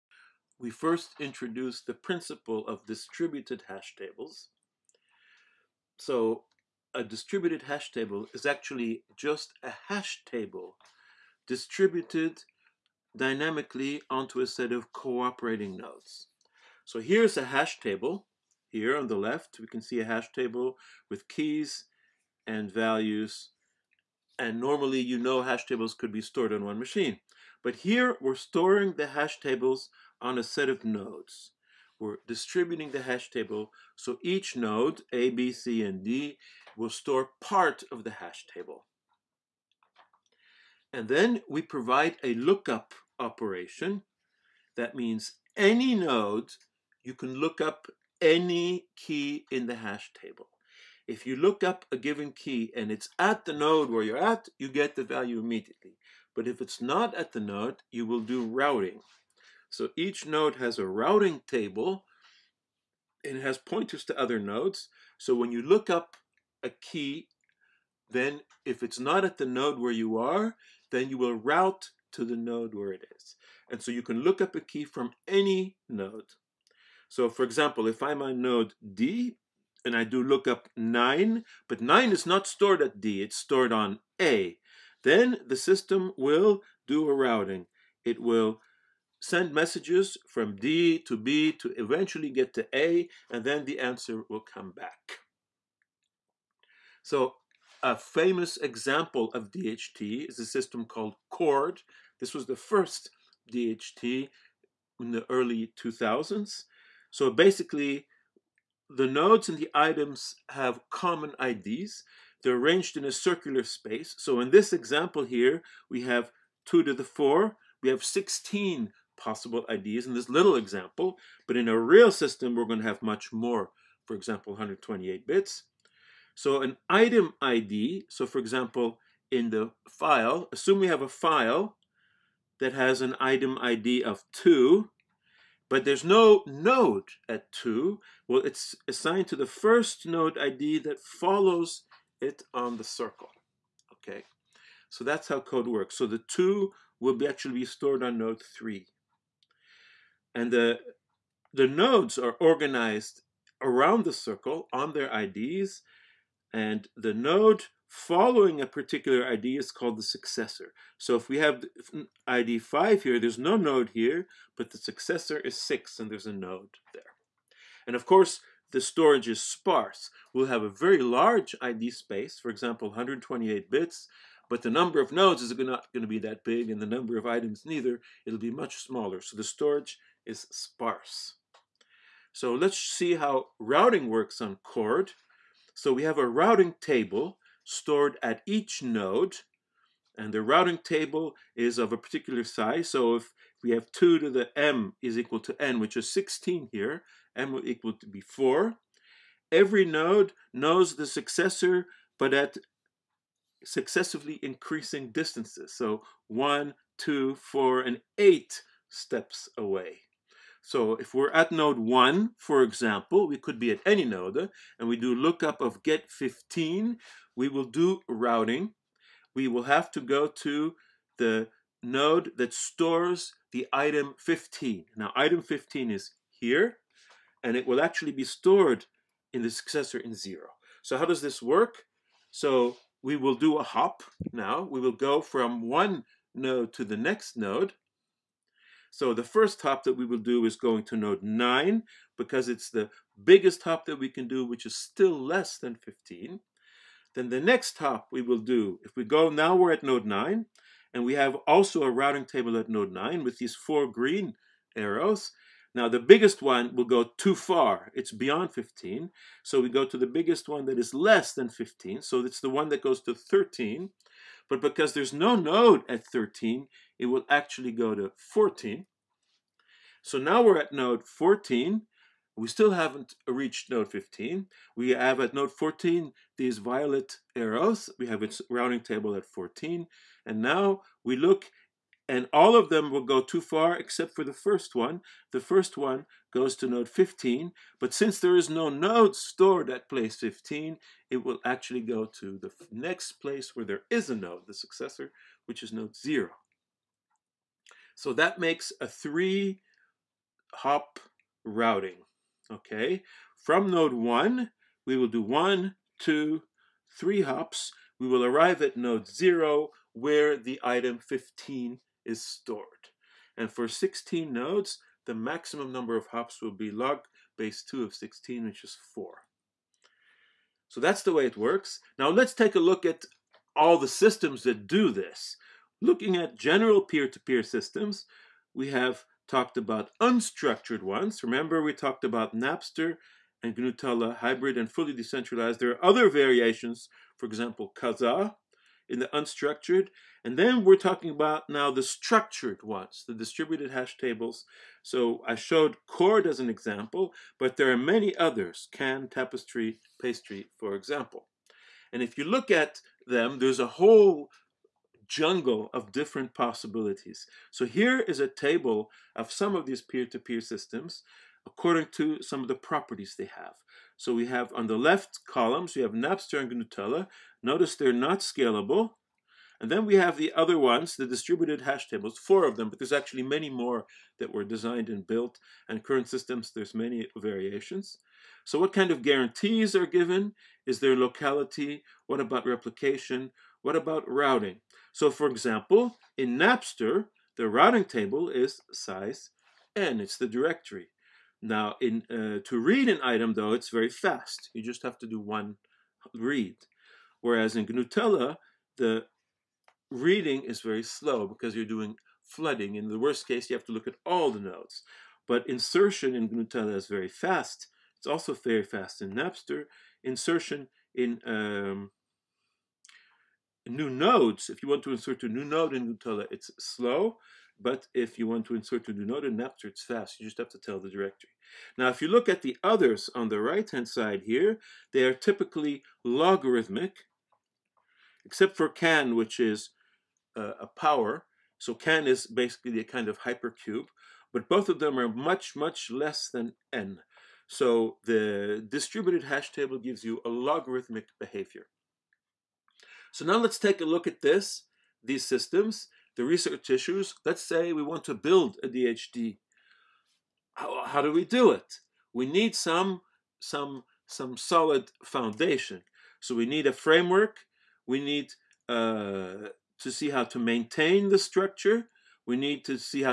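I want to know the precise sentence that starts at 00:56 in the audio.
But if it's not at the node, you will do routing.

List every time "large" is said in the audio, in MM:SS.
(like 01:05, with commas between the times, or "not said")
02:50.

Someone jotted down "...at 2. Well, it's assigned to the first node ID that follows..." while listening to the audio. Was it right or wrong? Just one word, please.
right.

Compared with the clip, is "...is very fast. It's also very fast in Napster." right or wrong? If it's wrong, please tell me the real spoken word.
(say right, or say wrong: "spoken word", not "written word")
right.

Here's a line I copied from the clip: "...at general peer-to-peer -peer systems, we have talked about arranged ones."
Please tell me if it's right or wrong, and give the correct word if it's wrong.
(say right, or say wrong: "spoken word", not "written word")
wrong: "unstructured", not "arranged".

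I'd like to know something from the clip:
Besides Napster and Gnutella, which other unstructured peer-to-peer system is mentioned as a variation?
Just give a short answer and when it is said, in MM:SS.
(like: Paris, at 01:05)
Kazaa, at 05:37.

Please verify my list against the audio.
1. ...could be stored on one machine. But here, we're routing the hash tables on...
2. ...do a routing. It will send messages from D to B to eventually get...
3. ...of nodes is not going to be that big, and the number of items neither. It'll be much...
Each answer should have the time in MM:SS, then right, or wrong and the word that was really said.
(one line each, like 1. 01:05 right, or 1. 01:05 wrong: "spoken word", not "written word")
1. 00:25 wrong: "storing", not "routing"
2. 01:26 right
3. 02:54 right.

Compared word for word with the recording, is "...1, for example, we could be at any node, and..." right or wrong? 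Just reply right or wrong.
right.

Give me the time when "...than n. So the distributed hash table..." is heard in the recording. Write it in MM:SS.
07:16.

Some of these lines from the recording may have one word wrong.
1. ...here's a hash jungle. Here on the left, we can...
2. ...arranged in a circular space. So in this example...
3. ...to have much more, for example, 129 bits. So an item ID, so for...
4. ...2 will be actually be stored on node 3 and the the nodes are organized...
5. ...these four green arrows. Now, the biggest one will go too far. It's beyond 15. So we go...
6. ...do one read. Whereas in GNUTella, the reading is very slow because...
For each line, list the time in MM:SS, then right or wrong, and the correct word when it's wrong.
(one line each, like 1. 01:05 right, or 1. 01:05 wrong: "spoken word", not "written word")
1. 00:16 wrong: "table", not "jungle"
2. 01:52 right
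3. 02:02 wrong: "128", not "129"
4. 02:26 right
5. 04:13 right
6. 06:35 right.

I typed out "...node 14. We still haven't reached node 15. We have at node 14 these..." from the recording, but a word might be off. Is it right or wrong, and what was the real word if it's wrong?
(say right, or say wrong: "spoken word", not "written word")
right.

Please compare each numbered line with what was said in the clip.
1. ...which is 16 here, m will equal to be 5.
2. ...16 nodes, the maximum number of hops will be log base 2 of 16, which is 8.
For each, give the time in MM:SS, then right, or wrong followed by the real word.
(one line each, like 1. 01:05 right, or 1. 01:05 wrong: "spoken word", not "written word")
1. 03:15 wrong: "4", not "5"
2. 05:13 wrong: "4", not "8".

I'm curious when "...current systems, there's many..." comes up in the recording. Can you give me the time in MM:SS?
06:15.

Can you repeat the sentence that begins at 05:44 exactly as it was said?
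So I showed Chord as an example, but there are many others, CAN, Tapestry, Pastry, for example.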